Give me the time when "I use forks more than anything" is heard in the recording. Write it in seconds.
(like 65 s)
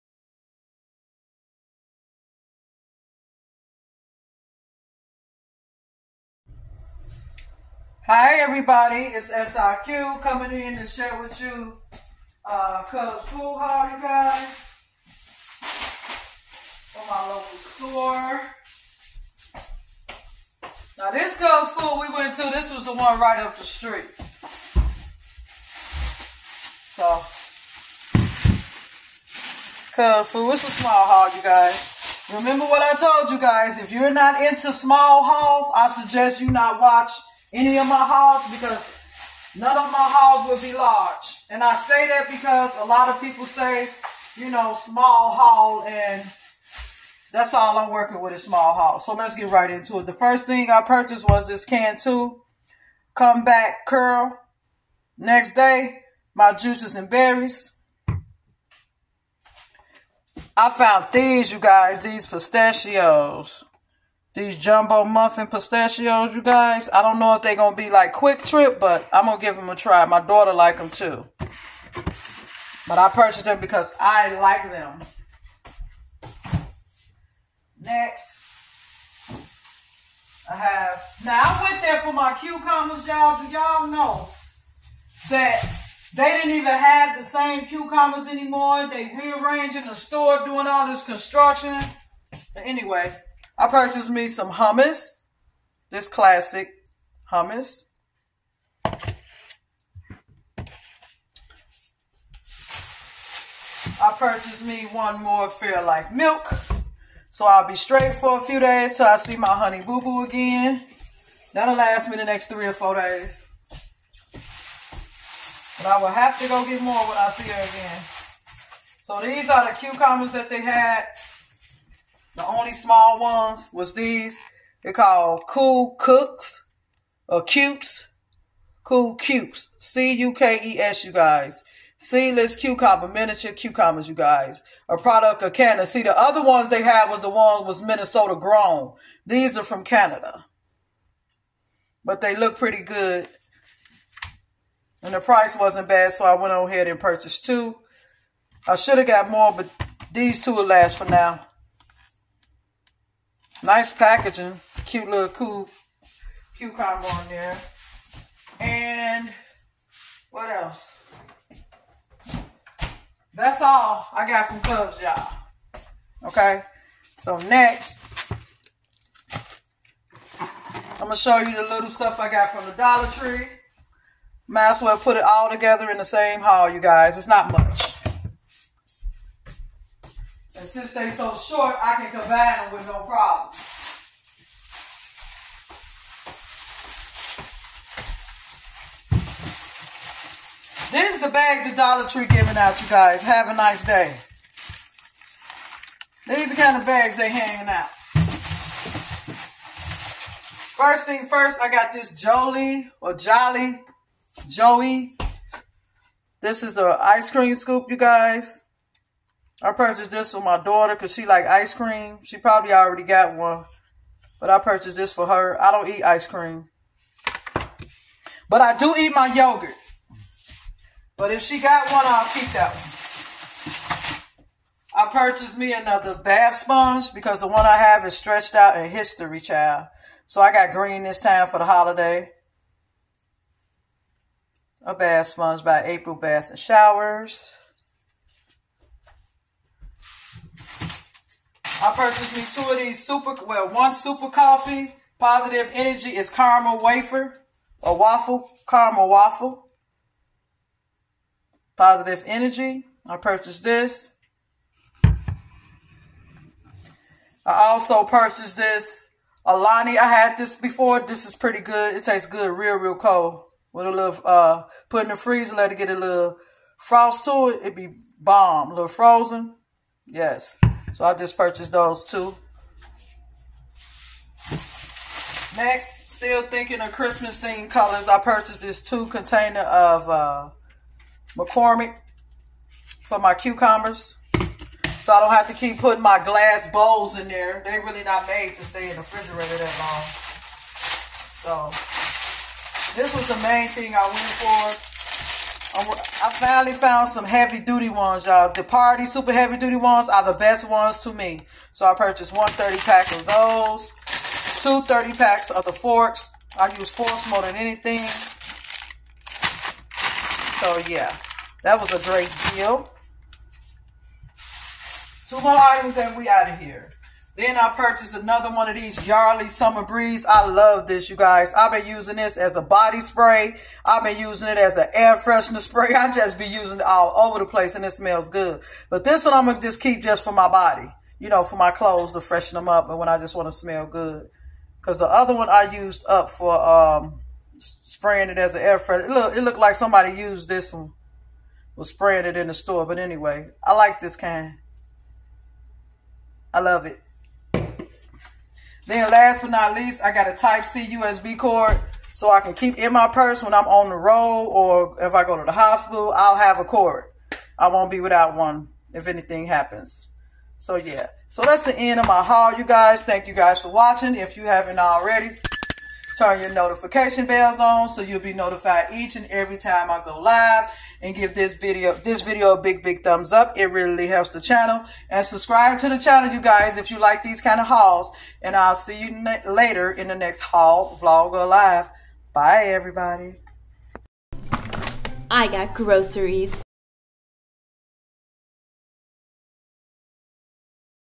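306 s.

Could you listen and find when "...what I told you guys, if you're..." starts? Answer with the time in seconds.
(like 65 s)
32 s.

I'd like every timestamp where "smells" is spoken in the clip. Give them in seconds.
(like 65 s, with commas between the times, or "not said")
327 s, 333 s.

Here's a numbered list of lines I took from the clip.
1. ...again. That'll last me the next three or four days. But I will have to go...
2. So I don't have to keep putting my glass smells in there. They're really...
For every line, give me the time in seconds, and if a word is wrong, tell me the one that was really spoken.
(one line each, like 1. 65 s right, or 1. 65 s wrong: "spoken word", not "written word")
1. 110 s right
2. 284 s wrong: "bowls", not "smells".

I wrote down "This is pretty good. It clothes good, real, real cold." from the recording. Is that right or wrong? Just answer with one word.
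wrong.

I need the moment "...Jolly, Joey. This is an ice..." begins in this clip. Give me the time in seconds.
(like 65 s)
203 s.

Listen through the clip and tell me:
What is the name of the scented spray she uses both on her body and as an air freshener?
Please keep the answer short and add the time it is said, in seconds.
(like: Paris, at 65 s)
Yardley Summer Breeze, at 319 s.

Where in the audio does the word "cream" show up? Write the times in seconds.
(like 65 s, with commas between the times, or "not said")
207 s, 211 s, 216 s.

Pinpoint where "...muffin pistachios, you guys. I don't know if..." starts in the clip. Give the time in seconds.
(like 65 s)
65 s.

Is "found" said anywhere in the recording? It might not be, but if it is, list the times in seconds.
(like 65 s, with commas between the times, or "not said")
60 s, 296 s.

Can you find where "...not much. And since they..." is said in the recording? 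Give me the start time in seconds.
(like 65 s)
177 s.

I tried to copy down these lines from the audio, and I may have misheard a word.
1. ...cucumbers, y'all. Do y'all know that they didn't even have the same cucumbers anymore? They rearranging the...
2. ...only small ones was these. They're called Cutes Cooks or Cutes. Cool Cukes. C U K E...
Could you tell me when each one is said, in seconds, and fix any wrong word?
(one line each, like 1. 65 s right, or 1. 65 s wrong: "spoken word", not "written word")
1. 82 s right
2. 122 s wrong: "Cool", not "Cutes".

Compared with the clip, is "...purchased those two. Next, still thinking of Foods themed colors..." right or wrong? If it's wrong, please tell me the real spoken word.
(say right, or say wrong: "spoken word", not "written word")
wrong: "Christmas", not "Foods".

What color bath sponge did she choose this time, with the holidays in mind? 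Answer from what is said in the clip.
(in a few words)
green.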